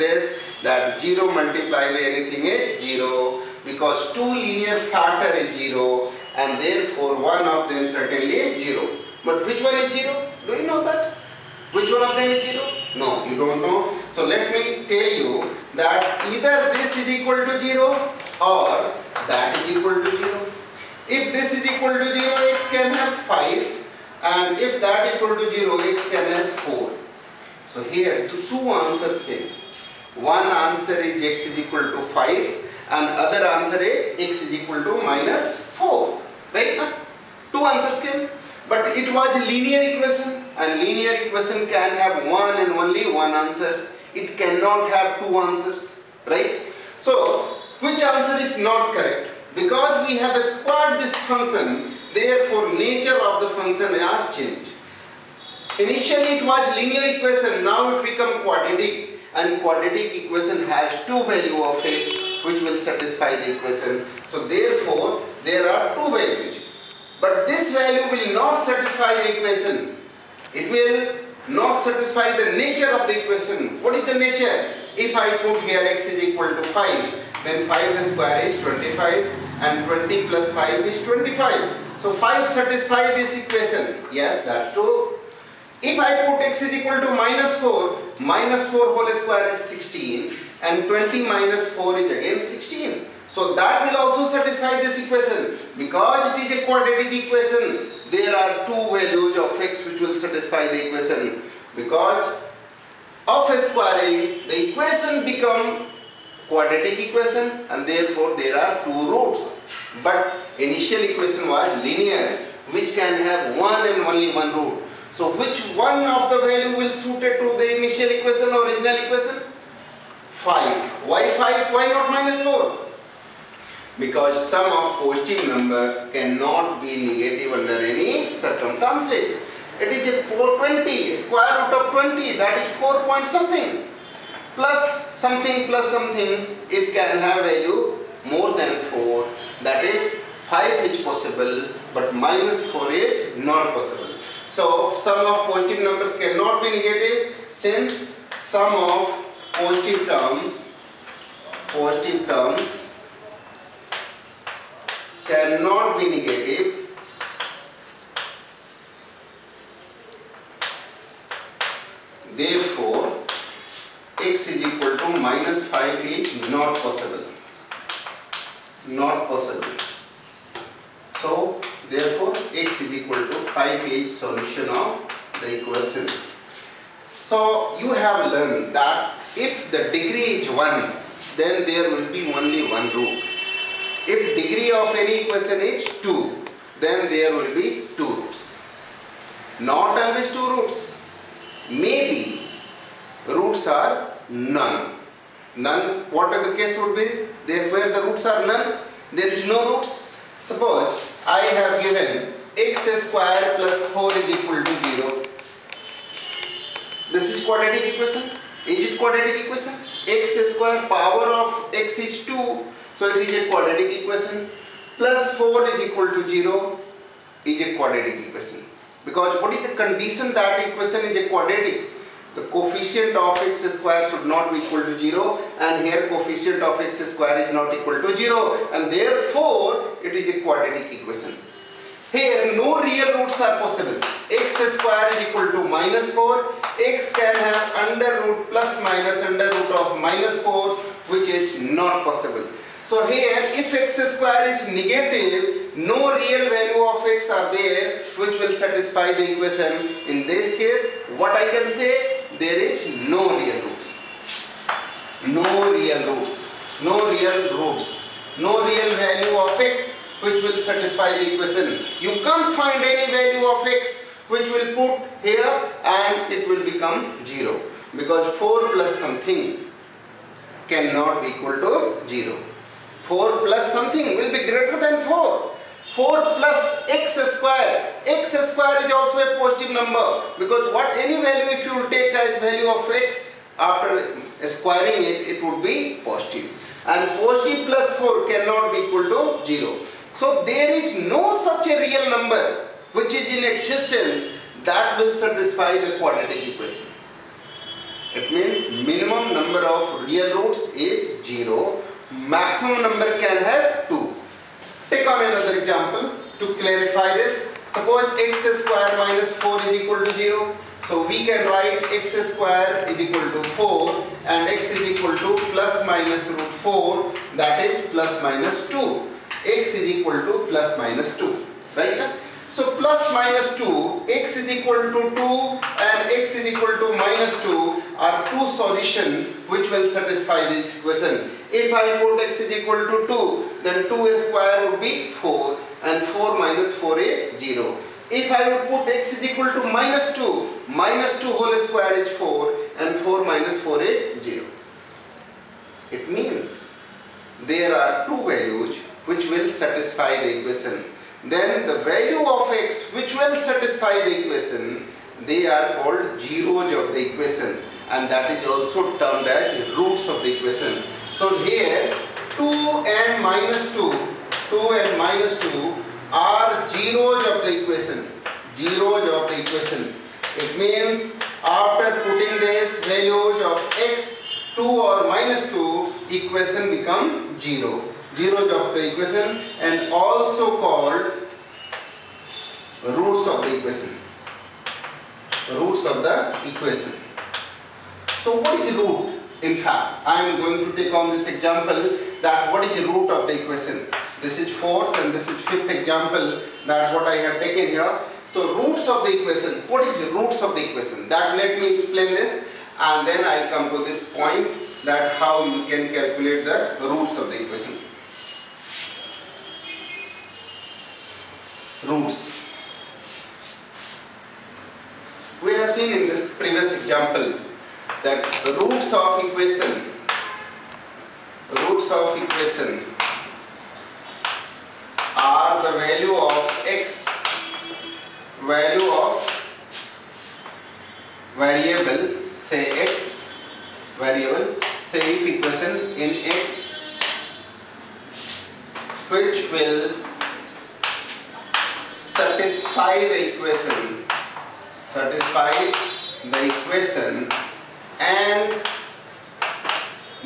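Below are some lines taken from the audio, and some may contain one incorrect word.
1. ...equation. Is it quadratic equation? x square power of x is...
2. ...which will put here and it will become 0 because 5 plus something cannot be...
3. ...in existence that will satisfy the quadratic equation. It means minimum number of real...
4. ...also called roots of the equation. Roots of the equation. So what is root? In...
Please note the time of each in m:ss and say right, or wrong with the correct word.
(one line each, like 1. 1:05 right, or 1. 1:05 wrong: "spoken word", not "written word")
1. 3:27 right
2. 4:24 wrong: "4", not "5"
3. 4:53 right
4. 6:19 right.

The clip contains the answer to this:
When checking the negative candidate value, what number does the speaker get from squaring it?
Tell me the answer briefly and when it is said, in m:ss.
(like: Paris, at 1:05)
16, at 1:28.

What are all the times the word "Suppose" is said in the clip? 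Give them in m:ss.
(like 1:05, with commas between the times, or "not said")
3:20, 5:07.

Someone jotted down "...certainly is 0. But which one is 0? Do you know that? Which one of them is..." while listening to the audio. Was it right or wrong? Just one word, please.
right.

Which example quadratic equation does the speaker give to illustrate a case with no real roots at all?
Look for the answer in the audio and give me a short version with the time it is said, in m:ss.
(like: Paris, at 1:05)
x square plus 4 = 0, at 3:22.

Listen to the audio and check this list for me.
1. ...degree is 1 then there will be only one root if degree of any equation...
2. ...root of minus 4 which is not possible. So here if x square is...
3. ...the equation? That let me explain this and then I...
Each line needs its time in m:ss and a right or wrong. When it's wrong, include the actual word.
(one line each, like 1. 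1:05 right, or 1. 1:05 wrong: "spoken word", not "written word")
1. 2:59 right
2. 3:59 right
3. 6:40 right.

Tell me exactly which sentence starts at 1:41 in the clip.
Because of squaring, the equation become quadratic equation and therefore there are two roots.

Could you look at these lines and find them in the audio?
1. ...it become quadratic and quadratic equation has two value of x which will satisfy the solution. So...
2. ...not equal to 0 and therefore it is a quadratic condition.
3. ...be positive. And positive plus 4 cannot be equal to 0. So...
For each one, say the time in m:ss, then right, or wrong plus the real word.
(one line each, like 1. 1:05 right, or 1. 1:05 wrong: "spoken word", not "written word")
1. 0:57 wrong: "equation", not "solution"
2. 3:47 wrong: "equation", not "condition"
3. 4:45 right.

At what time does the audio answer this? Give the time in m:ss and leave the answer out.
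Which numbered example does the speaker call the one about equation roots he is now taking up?
6:35.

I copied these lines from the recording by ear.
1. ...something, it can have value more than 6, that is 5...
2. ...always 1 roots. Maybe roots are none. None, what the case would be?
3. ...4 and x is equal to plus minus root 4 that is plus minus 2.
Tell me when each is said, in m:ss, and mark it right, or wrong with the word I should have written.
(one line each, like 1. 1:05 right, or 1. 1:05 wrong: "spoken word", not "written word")
1. 2:15 wrong: "4", not "6"
2. 3:10 wrong: "2", not "1"
3. 5:13 right.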